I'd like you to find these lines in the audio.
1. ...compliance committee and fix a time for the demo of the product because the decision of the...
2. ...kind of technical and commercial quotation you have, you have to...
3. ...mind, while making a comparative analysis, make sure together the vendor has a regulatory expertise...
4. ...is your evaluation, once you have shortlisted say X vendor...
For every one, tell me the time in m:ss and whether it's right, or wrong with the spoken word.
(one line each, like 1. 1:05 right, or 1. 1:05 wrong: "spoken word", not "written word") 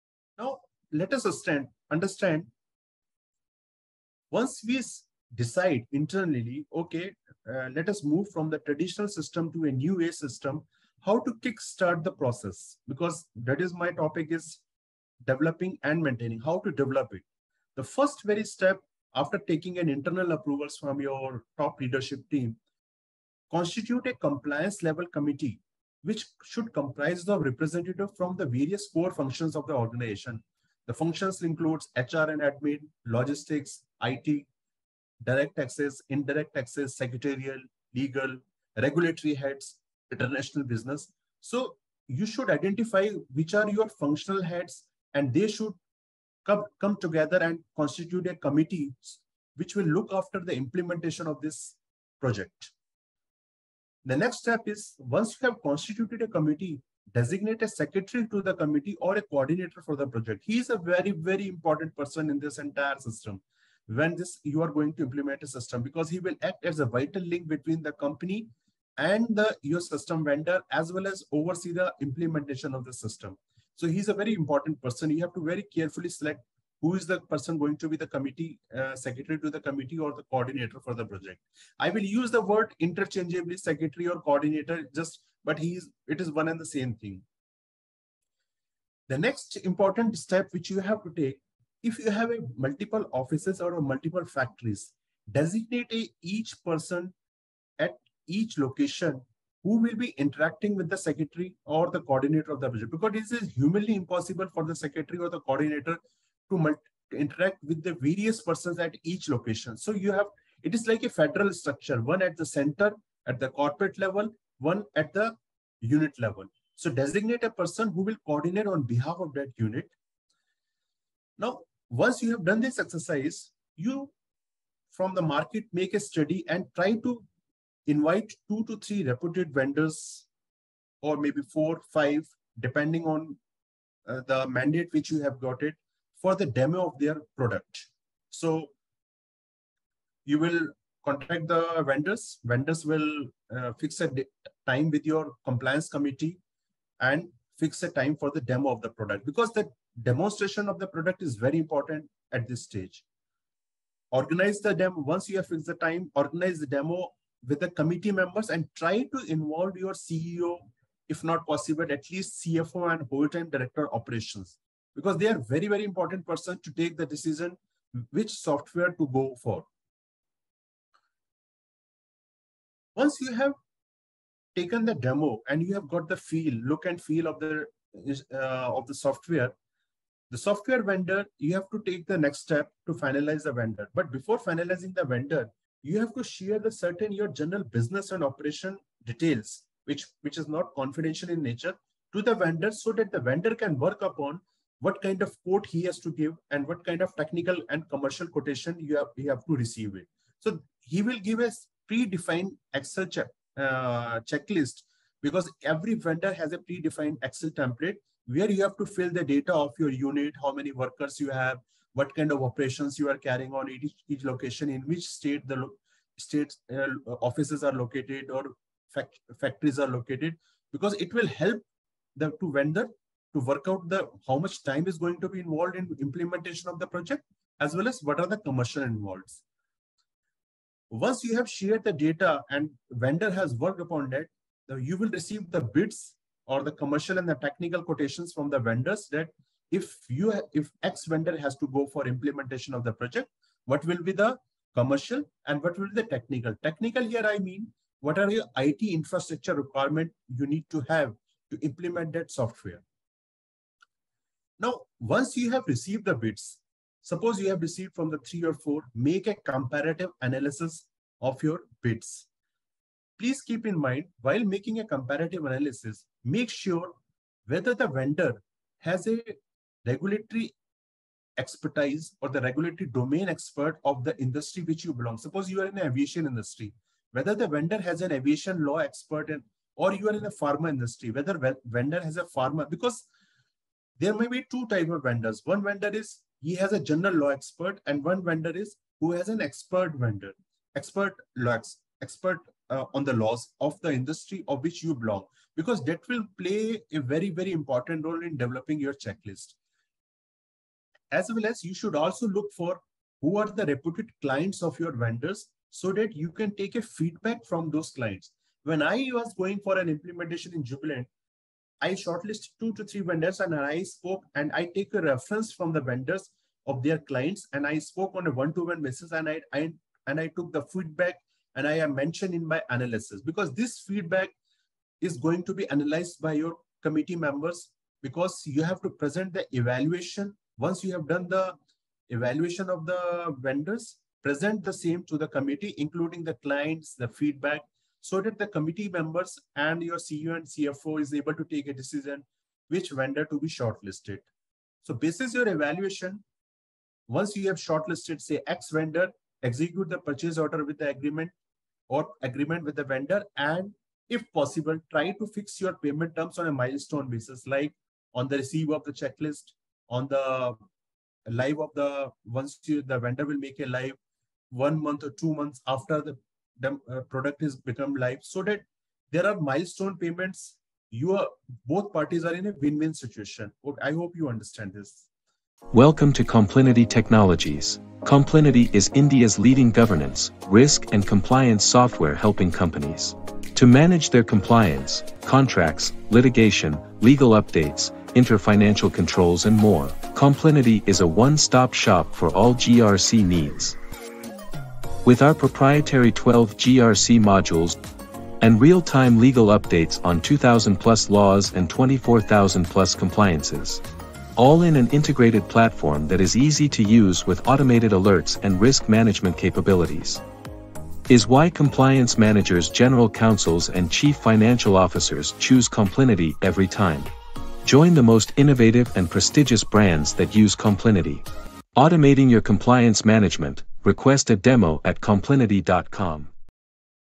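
1. 2:25 wrong: "demonstration", not "decision"
2. 3:16 right
3. 4:23 wrong: "whether", not "together"
4. 5:45 right.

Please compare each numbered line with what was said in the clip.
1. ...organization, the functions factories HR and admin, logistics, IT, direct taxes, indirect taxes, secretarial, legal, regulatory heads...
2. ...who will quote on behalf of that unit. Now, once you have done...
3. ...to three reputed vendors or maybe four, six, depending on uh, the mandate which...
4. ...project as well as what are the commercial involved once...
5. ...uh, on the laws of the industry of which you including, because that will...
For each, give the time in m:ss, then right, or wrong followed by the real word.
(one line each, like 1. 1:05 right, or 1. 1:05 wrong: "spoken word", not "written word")
1. 0:29 wrong: "includes", not "factories"
2. 1:57 wrong: "coordinate", not "quote"
3. 2:08 wrong: "five", not "six"
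4. 3:46 right
5. 4:52 wrong: "belong", not "including".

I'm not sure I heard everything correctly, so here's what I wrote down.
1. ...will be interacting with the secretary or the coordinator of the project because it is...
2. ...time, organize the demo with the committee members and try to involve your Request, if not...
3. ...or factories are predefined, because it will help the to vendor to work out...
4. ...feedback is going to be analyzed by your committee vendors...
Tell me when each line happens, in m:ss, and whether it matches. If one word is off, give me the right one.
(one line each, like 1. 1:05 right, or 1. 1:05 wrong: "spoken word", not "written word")
1. 1:39 right
2. 2:35 wrong: "CEO", not "Request"
3. 3:38 wrong: "located", not "predefined"
4. 5:23 wrong: "members", not "vendors".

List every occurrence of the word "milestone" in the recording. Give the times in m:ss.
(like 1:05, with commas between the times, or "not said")
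5:56, 6:09.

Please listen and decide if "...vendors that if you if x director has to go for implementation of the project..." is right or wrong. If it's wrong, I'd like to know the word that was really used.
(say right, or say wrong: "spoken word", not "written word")
wrong: "vendor", not "director".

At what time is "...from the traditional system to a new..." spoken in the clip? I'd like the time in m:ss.
0:08.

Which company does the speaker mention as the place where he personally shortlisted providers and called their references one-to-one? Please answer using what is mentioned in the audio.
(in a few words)
Jubilant.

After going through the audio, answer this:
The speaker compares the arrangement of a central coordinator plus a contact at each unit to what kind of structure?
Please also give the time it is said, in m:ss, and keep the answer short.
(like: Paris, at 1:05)
Federal structure, at 1:51.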